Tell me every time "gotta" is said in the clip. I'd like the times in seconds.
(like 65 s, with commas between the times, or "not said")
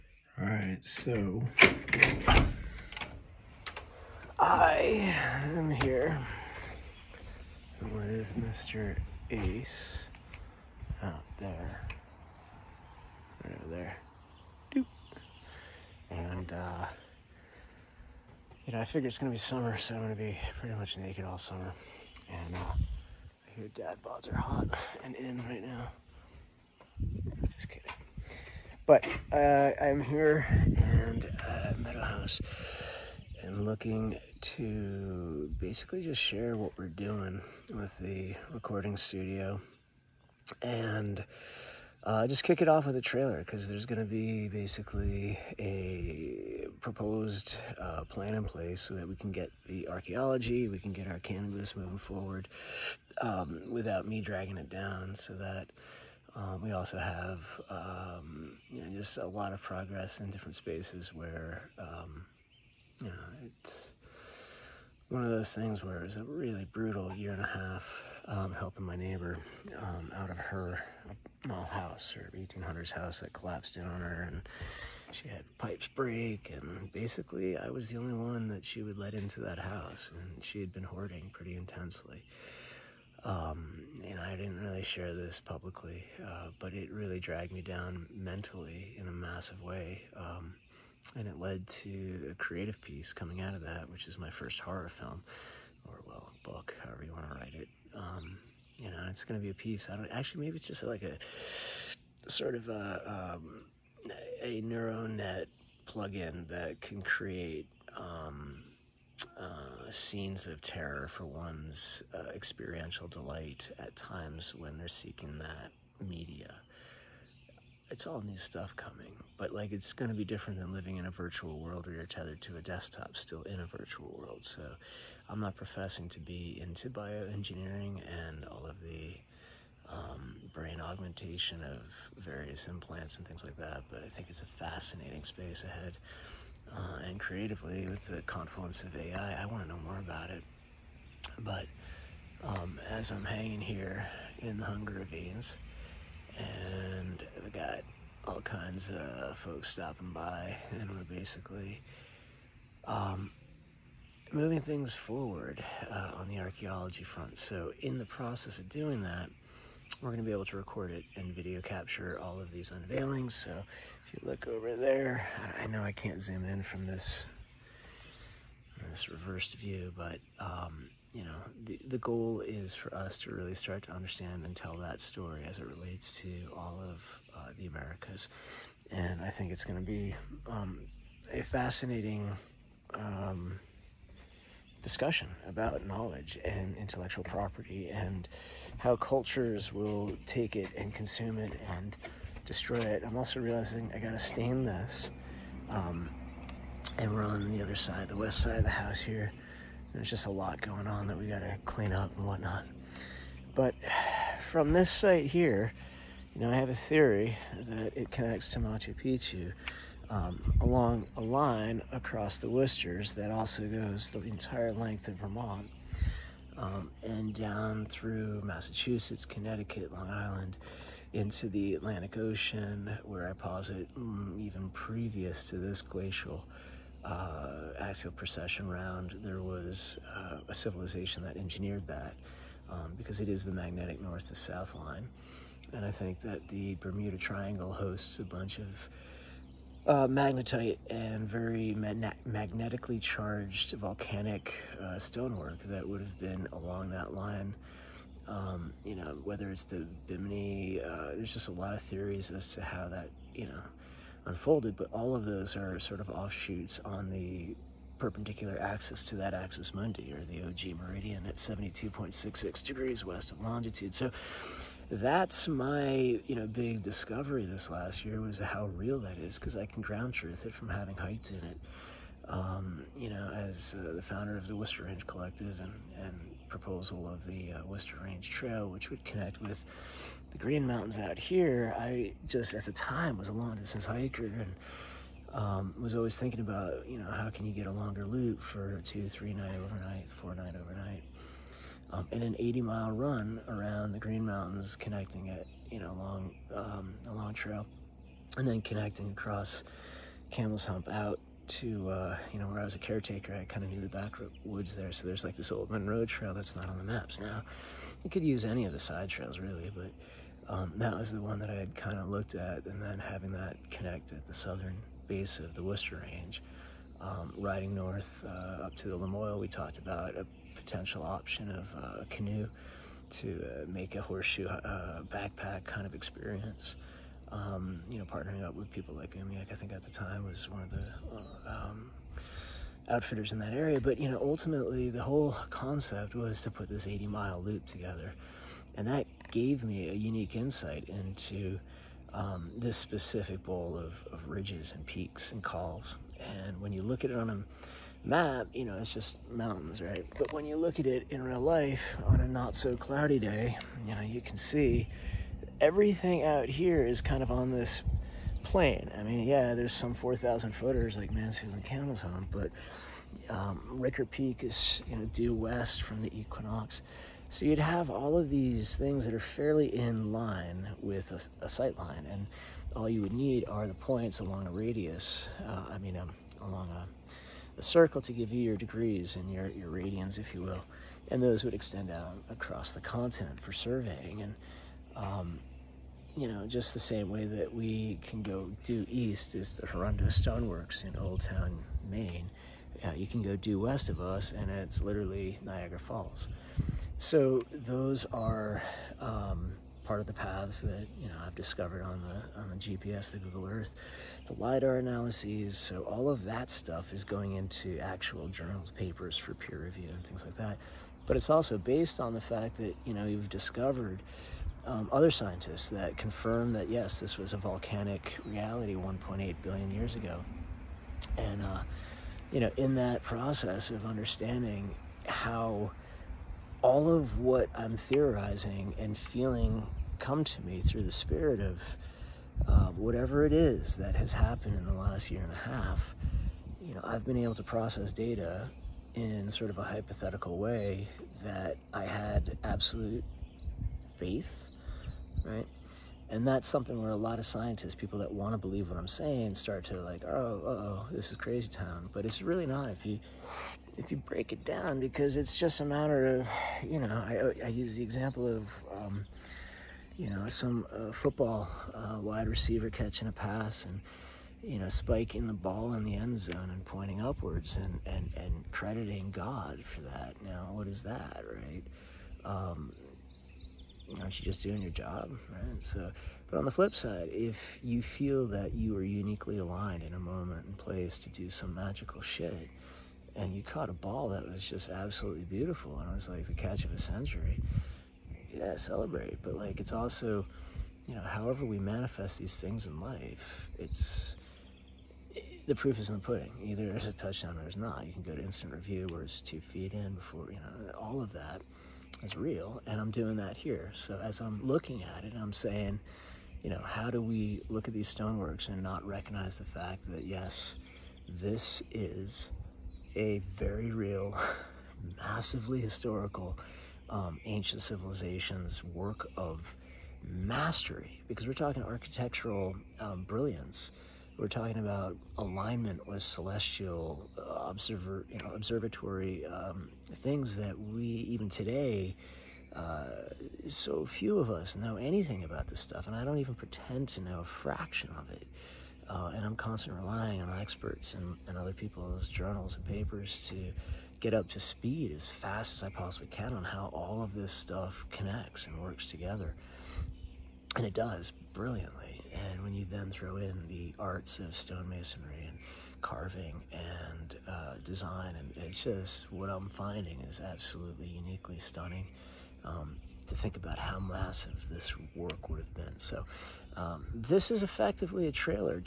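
193 s, 201 s.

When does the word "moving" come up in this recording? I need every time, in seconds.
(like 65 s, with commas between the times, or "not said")
51 s, 154 s.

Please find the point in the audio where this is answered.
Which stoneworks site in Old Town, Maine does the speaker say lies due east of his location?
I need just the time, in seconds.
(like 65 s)
389 s.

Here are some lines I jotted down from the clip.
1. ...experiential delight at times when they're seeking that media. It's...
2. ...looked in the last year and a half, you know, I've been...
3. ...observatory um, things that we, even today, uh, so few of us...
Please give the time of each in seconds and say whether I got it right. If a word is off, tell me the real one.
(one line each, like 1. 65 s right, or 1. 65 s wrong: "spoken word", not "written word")
1. 112 s right
2. 434 s wrong: "happened", not "looked"
3. 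528 s right.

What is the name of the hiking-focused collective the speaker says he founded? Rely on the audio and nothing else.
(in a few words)
Worcester Range Collective.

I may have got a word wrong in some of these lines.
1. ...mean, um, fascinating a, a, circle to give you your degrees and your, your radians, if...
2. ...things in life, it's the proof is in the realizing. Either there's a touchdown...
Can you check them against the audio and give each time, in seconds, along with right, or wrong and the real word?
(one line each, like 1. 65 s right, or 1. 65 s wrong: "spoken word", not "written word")
1. 375 s wrong: "along", not "fascinating"
2. 492 s wrong: "pudding", not "realizing".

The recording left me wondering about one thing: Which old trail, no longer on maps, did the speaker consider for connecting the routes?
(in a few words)
Monroe Trail.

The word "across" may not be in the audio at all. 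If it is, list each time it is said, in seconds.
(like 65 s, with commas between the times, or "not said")
211 s, 299 s, 382 s.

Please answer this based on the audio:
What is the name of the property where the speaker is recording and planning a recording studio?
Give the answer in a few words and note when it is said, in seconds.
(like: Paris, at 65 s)
Meadow House, at 31 s.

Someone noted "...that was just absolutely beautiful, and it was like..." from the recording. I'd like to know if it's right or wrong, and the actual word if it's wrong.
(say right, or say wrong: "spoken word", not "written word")
right.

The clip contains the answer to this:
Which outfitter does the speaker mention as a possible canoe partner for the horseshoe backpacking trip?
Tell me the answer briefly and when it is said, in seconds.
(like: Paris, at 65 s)
Umiak, at 329 s.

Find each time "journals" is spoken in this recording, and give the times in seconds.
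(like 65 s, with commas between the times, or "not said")
408 s, 542 s.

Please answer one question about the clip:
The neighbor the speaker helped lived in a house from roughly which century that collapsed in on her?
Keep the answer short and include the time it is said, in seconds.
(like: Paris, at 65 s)
1800s, at 72 s.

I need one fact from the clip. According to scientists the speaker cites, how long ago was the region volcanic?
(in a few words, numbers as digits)
1.8 billion years.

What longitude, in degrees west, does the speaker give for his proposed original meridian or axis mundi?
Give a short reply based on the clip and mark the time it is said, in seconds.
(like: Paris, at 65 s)
72.66 degrees, at 261 s.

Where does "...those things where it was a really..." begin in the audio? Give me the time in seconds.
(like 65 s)
65 s.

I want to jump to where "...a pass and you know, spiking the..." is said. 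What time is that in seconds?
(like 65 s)
463 s.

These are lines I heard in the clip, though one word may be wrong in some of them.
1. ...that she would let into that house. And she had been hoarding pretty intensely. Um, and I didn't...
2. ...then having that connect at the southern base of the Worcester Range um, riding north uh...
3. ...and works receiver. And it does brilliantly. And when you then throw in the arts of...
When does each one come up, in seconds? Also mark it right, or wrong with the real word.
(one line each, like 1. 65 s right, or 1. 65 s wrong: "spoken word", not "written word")
1. 78 s right
2. 312 s right
3. 548 s wrong: "together", not "receiver".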